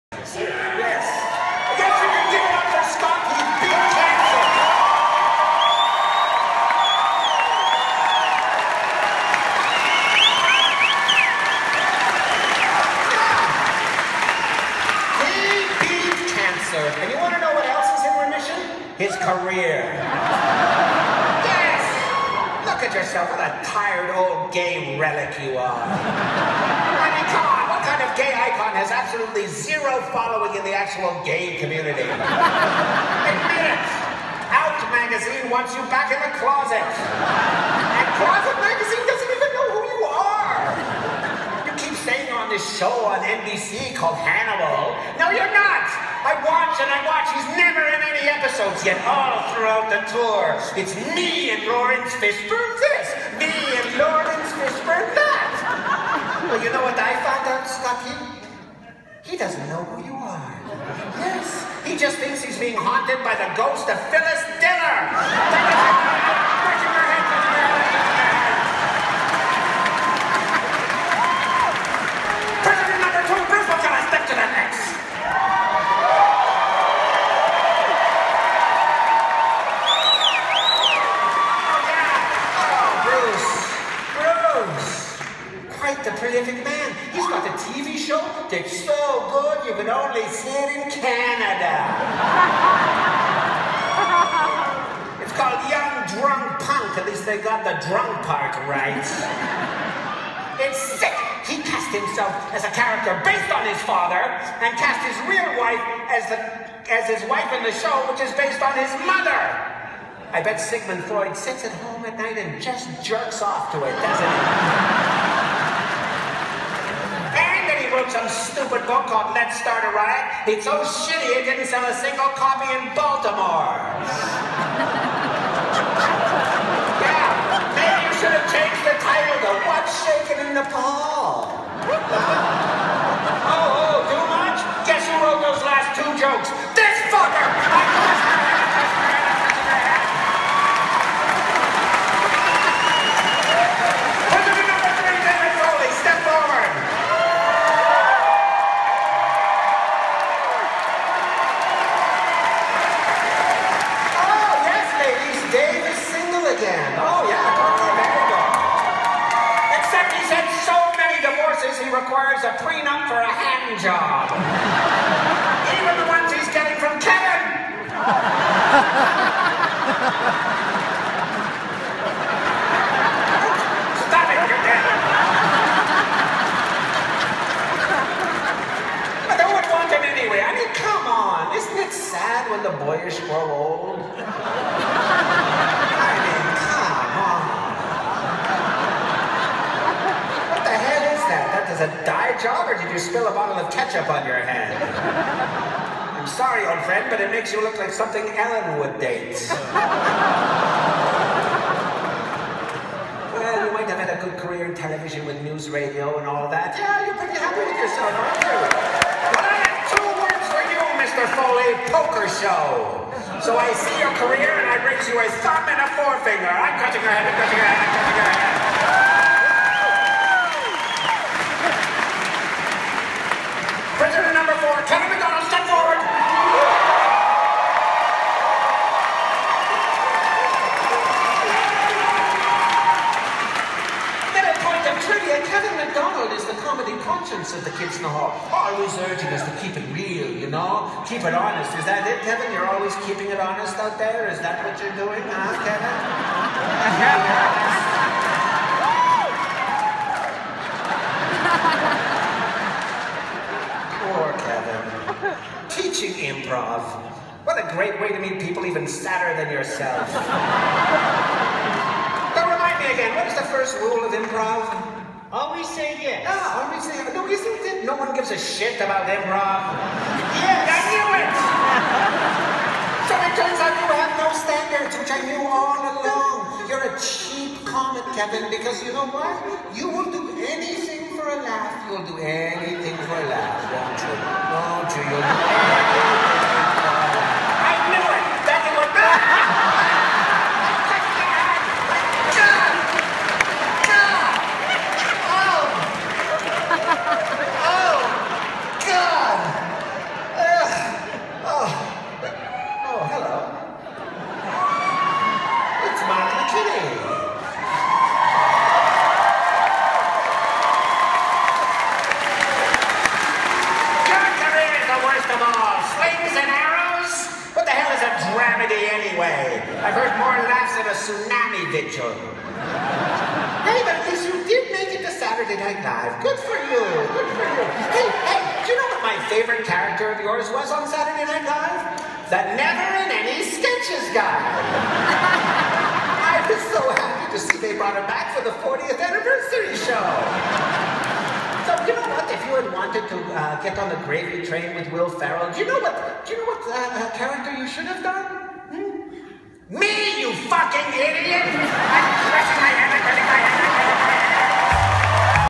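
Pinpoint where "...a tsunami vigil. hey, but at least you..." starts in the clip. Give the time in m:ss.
5:20.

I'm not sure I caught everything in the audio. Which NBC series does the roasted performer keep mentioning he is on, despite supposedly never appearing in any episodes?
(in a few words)
Hannibal.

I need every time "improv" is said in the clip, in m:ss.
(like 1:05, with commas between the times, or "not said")
4:16, 4:24, 4:29.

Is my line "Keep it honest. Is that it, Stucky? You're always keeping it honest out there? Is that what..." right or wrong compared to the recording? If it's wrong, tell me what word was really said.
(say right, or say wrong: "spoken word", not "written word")
wrong: "Kevin", not "Stucky".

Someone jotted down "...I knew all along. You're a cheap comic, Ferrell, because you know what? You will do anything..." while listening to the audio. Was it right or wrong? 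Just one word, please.
wrong.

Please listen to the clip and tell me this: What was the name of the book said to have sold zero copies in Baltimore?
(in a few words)
Let's Start a Riot.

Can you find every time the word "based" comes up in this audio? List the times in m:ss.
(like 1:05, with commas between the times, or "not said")
1:43, 1:48.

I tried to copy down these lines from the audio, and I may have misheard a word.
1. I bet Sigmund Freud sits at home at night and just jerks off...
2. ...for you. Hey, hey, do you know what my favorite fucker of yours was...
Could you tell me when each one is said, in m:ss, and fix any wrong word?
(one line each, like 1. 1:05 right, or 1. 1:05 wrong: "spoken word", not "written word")
1. 1:50 right
2. 5:27 wrong: "character", not "fucker".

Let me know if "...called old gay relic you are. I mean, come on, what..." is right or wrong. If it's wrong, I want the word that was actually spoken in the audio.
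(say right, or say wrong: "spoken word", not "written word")
wrong: "tired", not "called".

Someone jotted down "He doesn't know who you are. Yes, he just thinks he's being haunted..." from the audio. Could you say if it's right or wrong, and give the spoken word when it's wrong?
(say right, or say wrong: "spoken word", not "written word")
right.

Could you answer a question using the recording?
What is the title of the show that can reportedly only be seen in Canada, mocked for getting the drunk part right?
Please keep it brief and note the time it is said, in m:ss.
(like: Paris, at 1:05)
Young Drunk Punk, at 1:35.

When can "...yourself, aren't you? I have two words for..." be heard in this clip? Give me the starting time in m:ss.
3:27.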